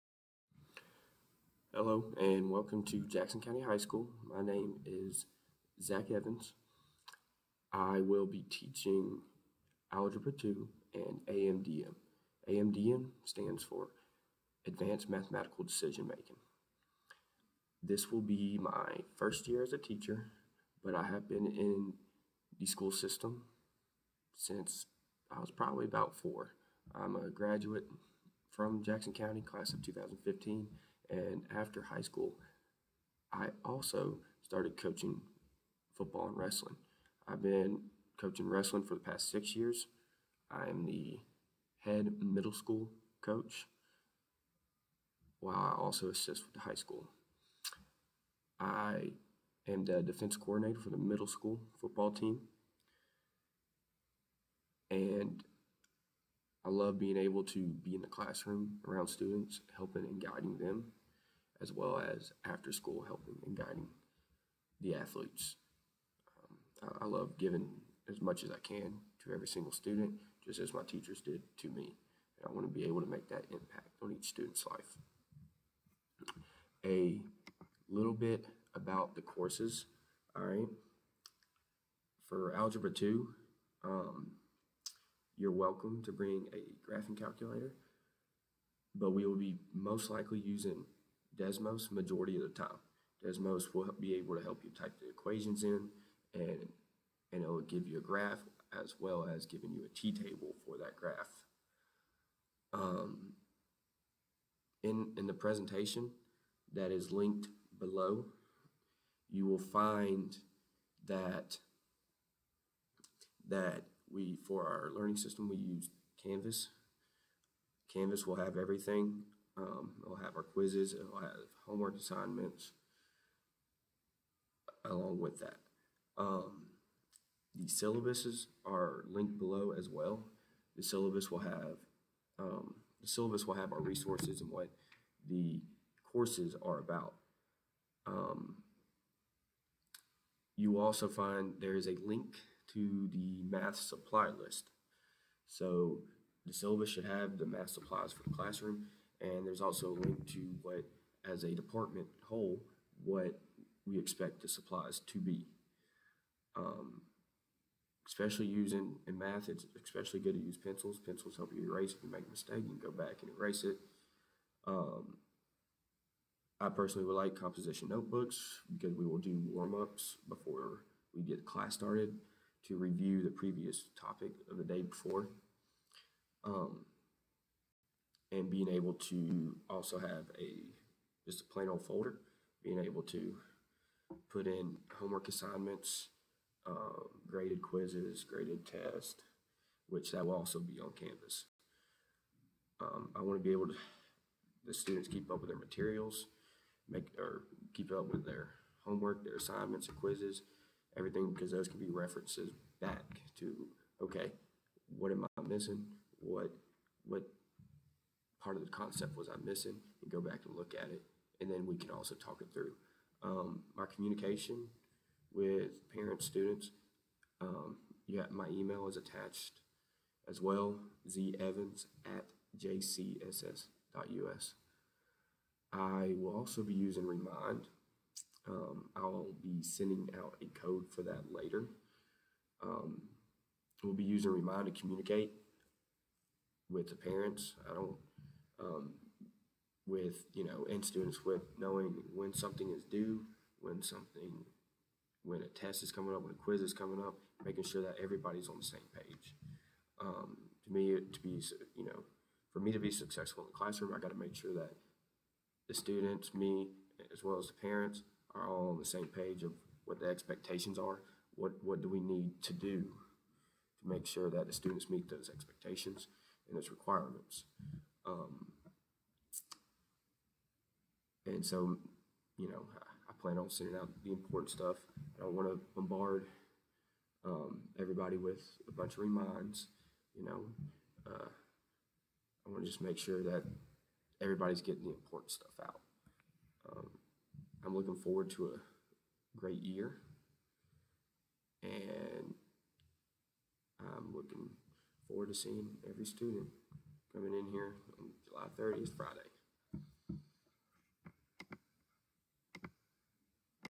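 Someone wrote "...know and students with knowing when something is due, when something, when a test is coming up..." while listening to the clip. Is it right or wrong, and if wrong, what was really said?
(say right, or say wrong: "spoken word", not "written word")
right.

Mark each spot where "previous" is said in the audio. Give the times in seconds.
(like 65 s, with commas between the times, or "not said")
173 s.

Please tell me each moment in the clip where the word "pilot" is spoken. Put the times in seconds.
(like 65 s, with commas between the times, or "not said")
not said.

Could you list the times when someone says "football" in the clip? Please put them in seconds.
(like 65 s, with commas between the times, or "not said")
35 s, 51 s.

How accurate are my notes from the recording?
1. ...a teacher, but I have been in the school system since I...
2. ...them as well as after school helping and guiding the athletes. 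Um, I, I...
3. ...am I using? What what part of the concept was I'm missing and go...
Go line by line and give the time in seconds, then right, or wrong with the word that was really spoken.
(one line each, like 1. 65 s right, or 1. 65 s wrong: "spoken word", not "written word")
1. 19 s right
2. 60 s right
3. 205 s wrong: "missing", not "using".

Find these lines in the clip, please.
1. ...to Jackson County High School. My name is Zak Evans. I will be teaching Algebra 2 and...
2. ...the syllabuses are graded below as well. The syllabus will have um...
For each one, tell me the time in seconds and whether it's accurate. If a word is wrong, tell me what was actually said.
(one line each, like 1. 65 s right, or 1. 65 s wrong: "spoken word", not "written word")
1. 2 s right
2. 127 s wrong: "linked", not "graded".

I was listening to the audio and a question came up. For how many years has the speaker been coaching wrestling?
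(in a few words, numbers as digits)
6.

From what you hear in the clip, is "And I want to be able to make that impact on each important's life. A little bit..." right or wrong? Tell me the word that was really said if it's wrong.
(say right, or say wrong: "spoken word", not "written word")
wrong: "student", not "important".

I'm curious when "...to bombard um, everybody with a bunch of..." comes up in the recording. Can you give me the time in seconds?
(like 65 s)
275 s.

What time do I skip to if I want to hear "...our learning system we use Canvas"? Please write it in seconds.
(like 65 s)
114 s.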